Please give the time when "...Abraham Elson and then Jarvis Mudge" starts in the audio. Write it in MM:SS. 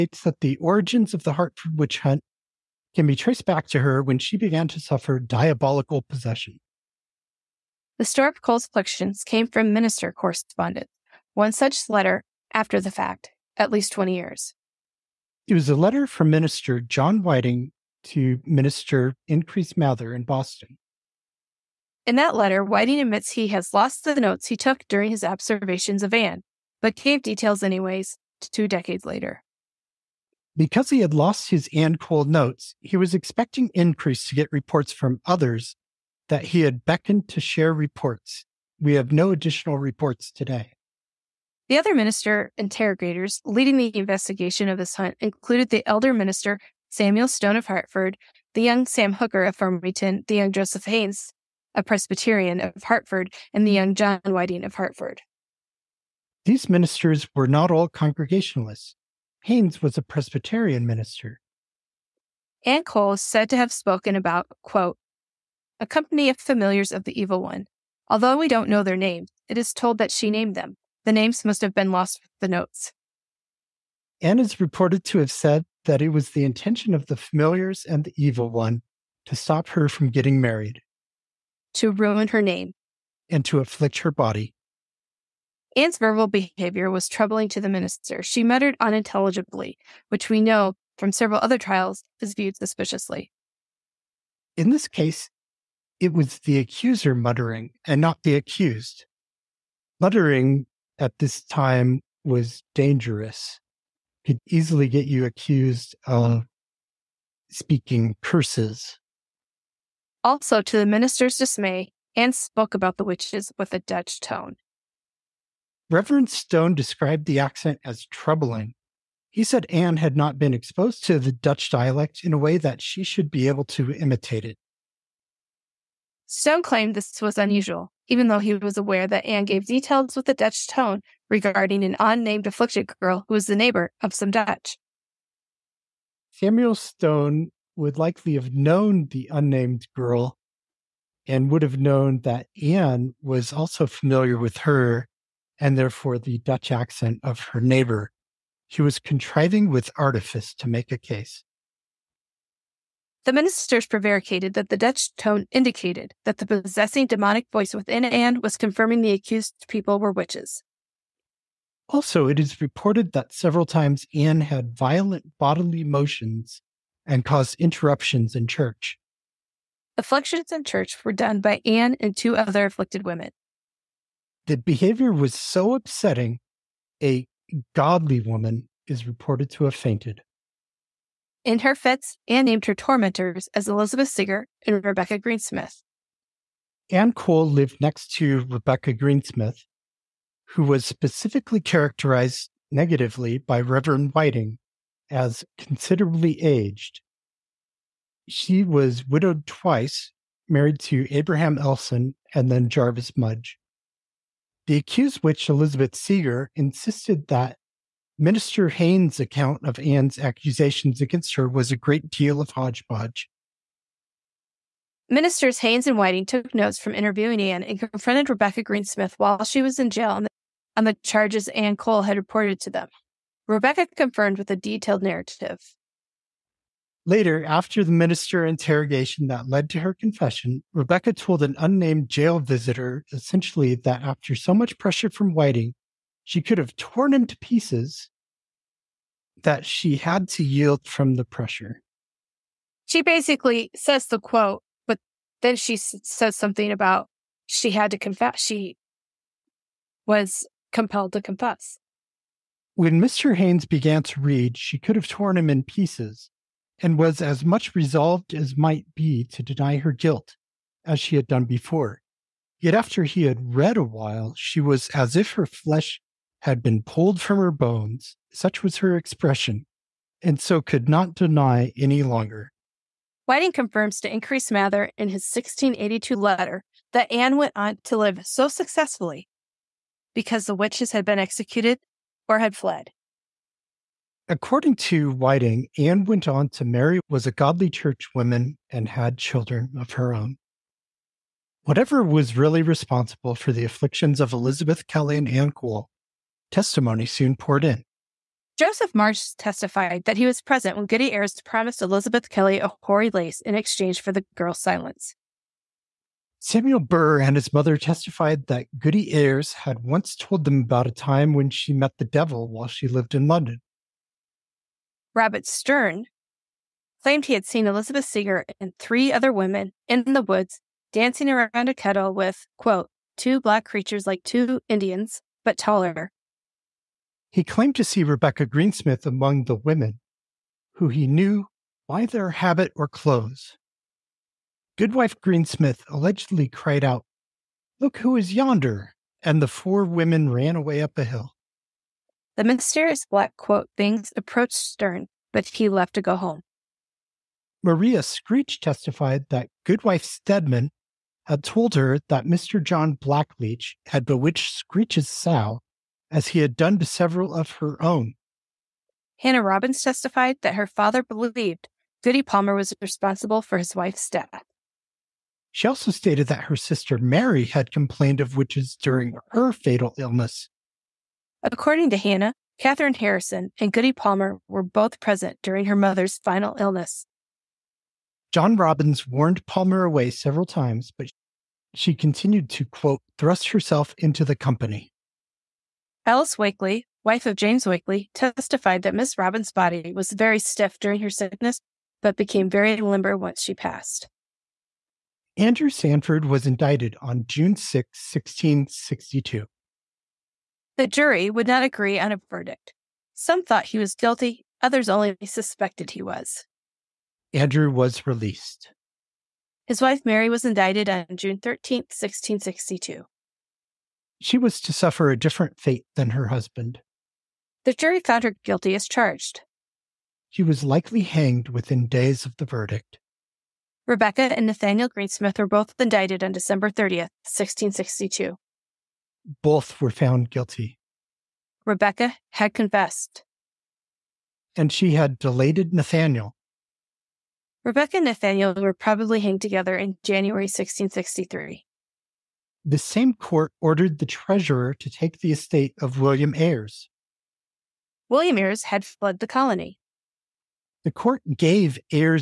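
03:21.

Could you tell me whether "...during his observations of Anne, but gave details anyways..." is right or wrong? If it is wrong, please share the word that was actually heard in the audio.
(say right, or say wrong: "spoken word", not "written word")
right.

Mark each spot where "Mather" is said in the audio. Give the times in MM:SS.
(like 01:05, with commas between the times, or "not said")
00:19, 04:34.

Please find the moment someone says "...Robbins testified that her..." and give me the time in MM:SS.
05:59.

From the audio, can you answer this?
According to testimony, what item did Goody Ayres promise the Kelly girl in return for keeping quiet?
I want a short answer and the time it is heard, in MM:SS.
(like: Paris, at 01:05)
a hoary lace, at 05:02.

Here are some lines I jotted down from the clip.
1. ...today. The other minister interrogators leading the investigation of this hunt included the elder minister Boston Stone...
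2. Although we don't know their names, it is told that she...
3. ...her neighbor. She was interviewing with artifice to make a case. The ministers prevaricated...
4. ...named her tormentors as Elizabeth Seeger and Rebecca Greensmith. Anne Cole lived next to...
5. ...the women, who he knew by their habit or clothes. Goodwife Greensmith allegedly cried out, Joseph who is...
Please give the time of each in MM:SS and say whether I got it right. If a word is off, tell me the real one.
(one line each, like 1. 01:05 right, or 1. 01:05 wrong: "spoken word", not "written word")
1. 00:40 wrong: "Samuel", not "Boston"
2. 01:08 right
3. 02:27 wrong: "contriving", not "interviewing"
4. 03:02 right
5. 05:29 wrong: "Look", not "Joseph".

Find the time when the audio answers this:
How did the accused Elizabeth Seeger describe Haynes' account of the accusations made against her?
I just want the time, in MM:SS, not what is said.
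03:31.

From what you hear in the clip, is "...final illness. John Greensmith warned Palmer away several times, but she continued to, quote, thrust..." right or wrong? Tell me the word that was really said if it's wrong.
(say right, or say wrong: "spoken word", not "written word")
wrong: "Robbins", not "Greensmith".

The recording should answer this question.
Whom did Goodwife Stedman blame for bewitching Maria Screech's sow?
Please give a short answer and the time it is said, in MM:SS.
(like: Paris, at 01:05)
John Blackleach, at 05:52.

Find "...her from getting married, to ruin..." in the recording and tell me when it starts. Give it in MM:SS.
01:19.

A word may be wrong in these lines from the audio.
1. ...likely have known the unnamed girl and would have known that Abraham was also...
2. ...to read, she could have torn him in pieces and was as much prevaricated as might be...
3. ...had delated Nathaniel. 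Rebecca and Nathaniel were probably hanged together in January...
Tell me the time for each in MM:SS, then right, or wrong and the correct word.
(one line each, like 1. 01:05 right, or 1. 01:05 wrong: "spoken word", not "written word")
1. 02:17 wrong: "Anne", not "Abraham"
2. 04:14 wrong: "resolved", not "prevaricated"
3. 07:14 right.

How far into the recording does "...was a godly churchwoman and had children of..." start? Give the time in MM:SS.
04:47.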